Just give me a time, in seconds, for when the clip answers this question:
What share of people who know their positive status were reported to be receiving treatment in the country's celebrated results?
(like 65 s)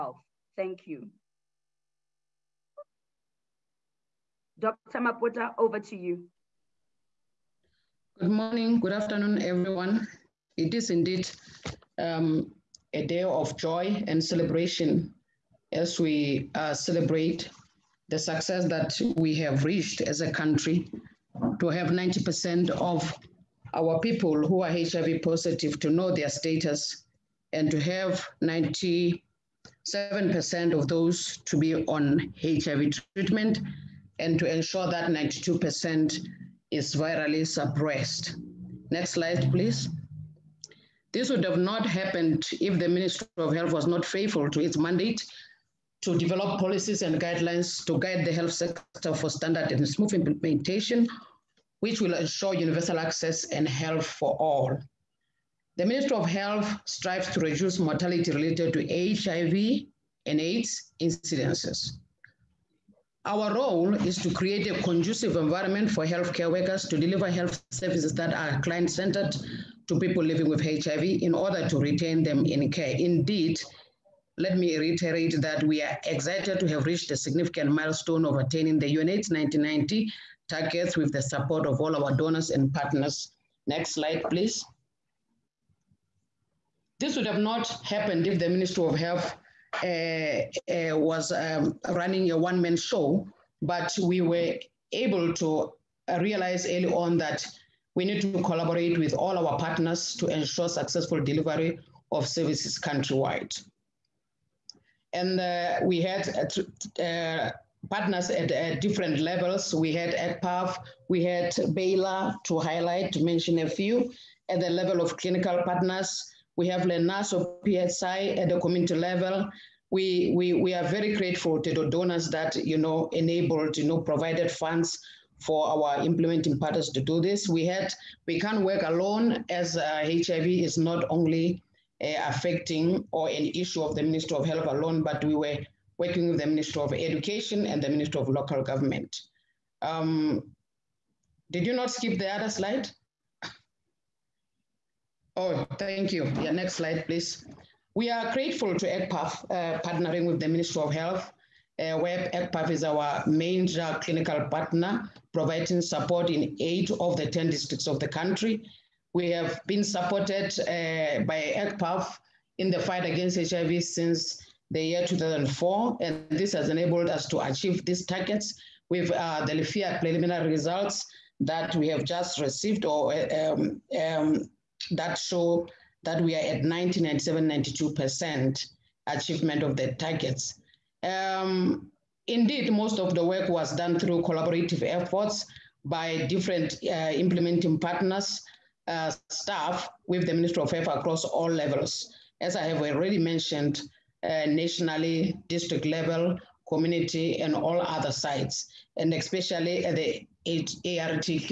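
28 s.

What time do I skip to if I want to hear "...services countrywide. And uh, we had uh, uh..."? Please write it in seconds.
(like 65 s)
102 s.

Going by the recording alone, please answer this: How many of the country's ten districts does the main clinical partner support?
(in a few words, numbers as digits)
8.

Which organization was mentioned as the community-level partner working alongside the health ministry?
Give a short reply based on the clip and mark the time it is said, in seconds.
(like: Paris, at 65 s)
Lenaso PSI, at 116 s.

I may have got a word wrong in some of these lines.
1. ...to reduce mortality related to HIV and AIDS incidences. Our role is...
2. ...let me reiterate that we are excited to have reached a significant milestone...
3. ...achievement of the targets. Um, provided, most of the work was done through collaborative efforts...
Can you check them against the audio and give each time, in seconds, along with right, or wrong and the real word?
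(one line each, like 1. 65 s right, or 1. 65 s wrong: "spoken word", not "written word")
1. 57 s right
2. 74 s right
3. 179 s wrong: "indeed", not "provided".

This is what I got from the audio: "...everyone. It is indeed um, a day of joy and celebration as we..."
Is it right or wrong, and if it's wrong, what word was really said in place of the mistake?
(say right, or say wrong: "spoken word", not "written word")
right.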